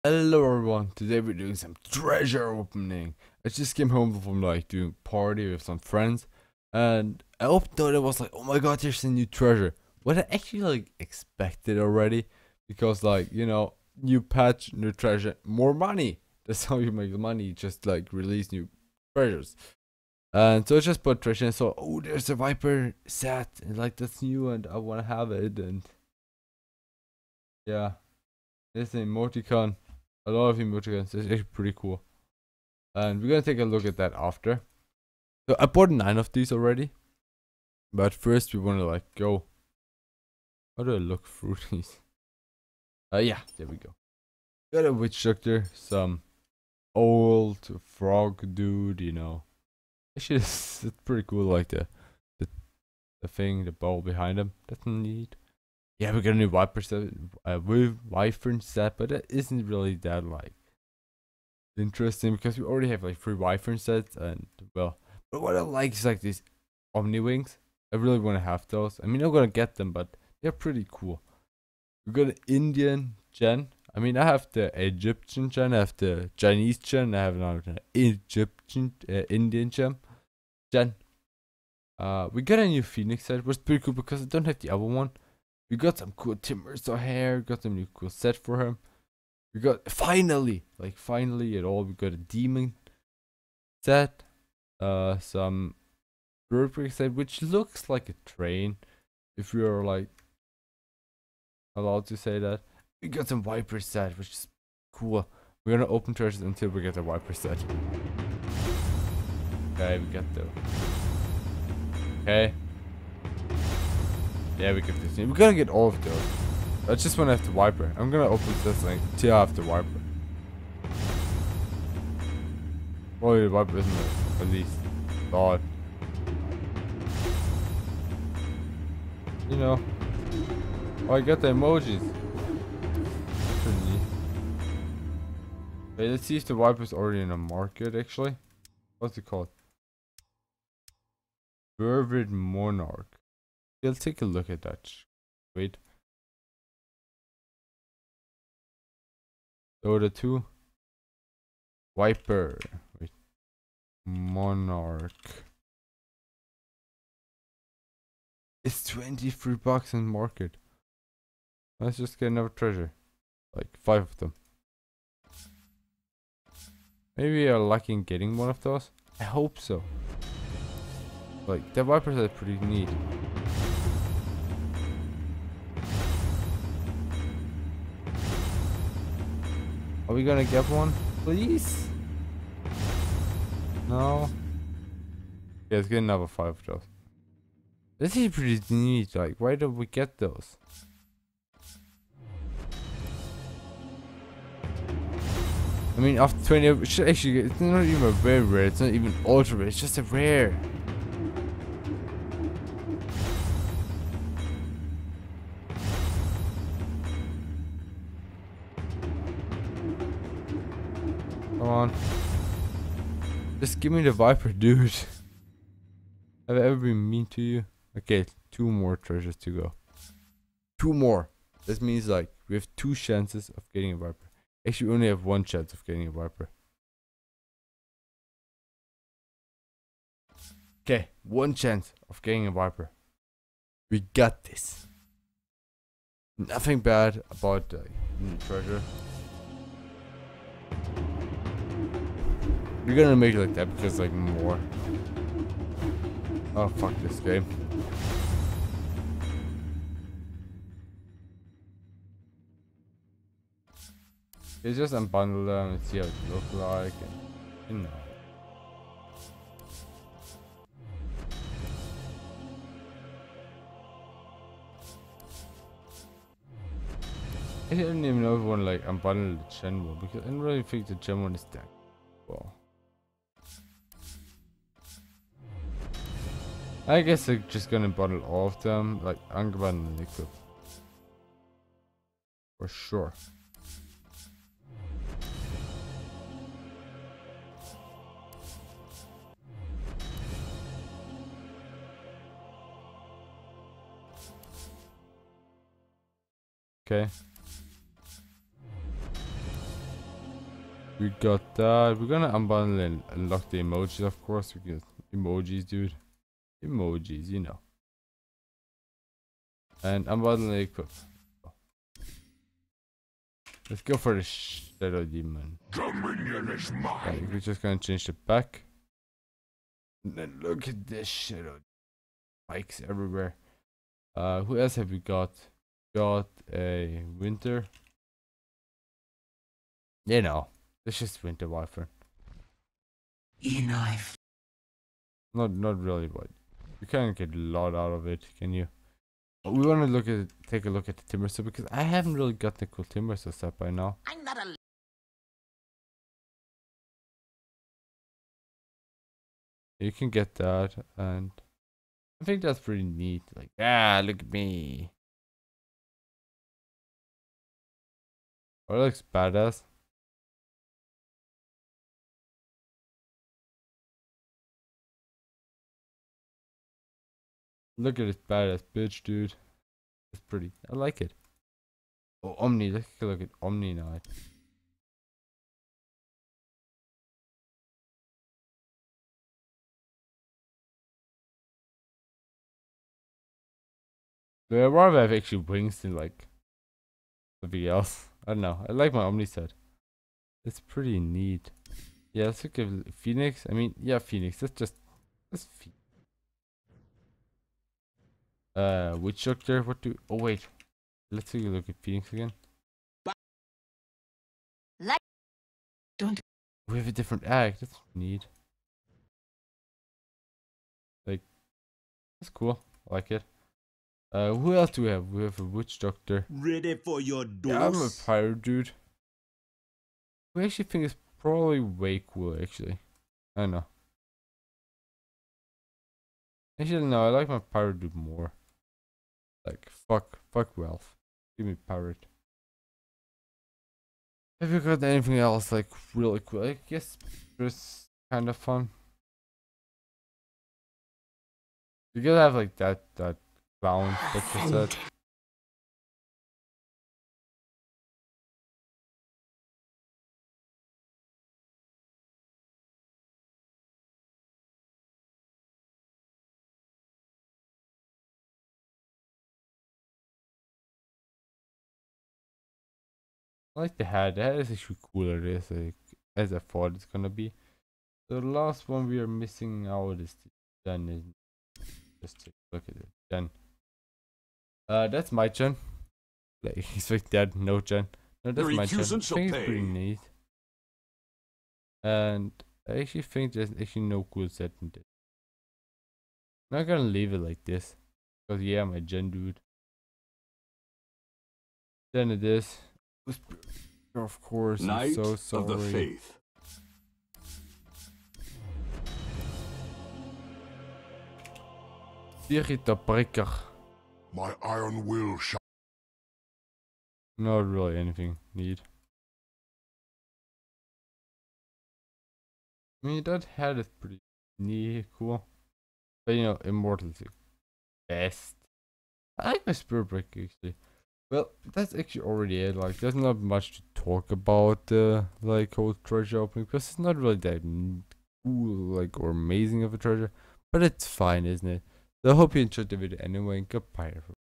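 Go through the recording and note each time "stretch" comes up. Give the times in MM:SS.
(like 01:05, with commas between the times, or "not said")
not said.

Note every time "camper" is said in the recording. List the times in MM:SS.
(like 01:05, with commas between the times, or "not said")
not said.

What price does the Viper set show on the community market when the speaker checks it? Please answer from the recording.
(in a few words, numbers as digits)
23 bucks.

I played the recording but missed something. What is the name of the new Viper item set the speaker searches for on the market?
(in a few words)
Vervid Monarch.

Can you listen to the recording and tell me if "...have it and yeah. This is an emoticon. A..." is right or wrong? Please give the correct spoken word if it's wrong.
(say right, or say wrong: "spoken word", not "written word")
right.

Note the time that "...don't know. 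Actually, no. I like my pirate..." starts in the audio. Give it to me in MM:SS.
07:03.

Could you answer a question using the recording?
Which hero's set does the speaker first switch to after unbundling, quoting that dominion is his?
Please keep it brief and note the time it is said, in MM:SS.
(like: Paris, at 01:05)
Shadow Demon, at 05:14.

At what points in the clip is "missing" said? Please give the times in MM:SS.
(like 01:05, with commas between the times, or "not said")
07:49.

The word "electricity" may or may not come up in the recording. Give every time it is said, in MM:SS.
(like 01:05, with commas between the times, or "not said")
not said.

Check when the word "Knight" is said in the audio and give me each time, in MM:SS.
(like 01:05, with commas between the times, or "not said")
06:13, 08:14.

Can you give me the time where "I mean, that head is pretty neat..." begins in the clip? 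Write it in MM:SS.
08:32.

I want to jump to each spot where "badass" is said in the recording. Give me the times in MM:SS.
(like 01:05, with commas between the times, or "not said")
05:59, 06:08.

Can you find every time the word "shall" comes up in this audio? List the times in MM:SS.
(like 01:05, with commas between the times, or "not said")
08:25.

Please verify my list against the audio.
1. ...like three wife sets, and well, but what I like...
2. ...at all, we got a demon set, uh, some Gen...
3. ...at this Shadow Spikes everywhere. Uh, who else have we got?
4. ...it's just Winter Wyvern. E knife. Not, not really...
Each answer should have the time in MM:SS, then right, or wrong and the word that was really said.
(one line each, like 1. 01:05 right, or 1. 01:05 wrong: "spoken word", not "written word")
1. 01:03 right
2. 01:31 wrong: "Birdbrick", not "Gen"
3. 05:20 right
4. 05:30 right.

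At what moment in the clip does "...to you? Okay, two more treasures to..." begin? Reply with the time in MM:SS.
03:37.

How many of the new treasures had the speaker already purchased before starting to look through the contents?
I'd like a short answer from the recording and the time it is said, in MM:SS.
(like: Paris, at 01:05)
9, at 00:35.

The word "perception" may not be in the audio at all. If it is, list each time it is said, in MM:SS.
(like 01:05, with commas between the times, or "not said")
00:56.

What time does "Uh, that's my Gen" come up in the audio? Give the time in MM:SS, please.
07:54.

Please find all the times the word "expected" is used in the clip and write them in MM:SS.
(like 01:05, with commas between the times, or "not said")
00:11.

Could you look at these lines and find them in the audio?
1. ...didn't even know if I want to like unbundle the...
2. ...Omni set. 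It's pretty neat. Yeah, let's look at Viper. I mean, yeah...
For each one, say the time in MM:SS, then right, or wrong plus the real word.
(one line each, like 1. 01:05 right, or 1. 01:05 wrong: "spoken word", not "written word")
1. 04:27 right
2. 06:29 wrong: "Phoenix", not "Viper".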